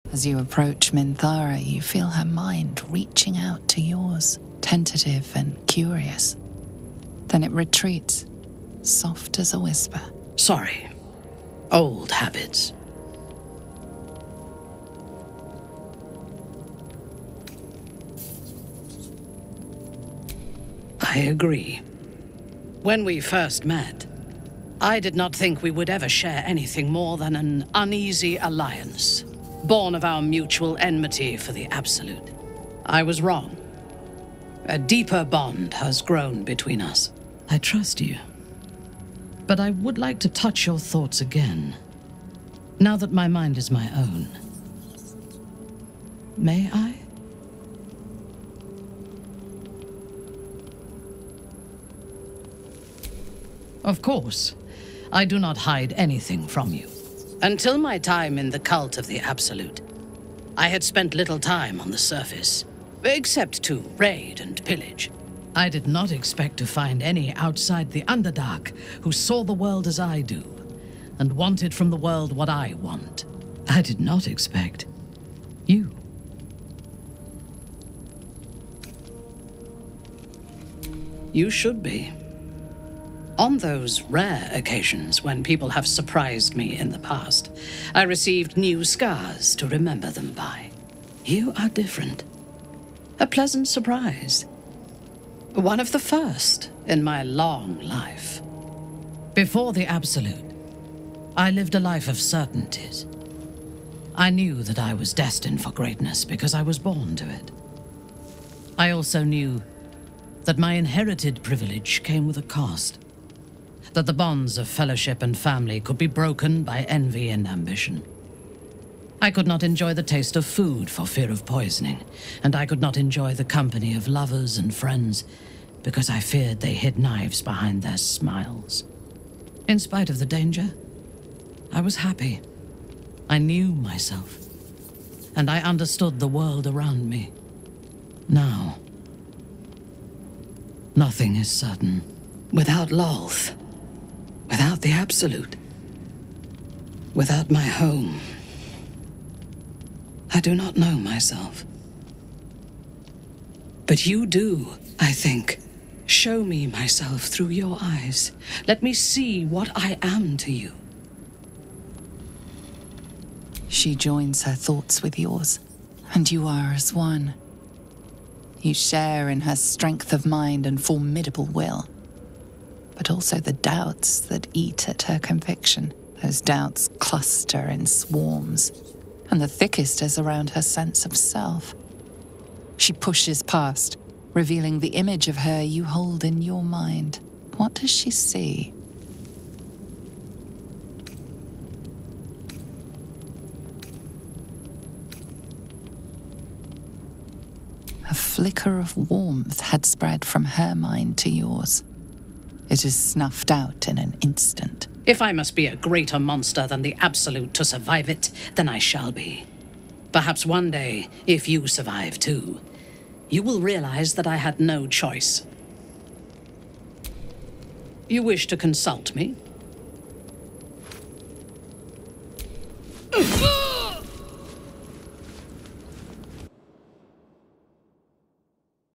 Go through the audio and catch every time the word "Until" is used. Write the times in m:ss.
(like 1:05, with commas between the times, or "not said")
0:57.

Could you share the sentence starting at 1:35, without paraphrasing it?
One of the first in my long life.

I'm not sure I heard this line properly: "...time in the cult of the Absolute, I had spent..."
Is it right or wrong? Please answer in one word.
right.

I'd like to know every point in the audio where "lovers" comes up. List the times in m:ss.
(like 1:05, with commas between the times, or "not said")
2:04.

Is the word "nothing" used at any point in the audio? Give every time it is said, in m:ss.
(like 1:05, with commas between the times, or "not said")
2:20.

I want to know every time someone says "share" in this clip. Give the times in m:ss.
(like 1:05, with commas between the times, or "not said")
0:26, 2:48.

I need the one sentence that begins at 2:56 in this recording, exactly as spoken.
Those doubts cluster in swarms, and the thickest is around her sense of self.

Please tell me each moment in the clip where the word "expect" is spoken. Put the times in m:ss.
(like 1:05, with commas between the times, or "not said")
1:06, 1:14.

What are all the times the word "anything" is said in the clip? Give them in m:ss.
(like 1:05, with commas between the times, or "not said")
0:26, 0:55.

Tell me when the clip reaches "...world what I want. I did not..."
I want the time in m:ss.
1:11.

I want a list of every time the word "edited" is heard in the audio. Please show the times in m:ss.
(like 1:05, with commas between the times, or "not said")
not said.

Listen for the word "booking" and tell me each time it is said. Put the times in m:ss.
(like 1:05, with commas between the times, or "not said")
not said.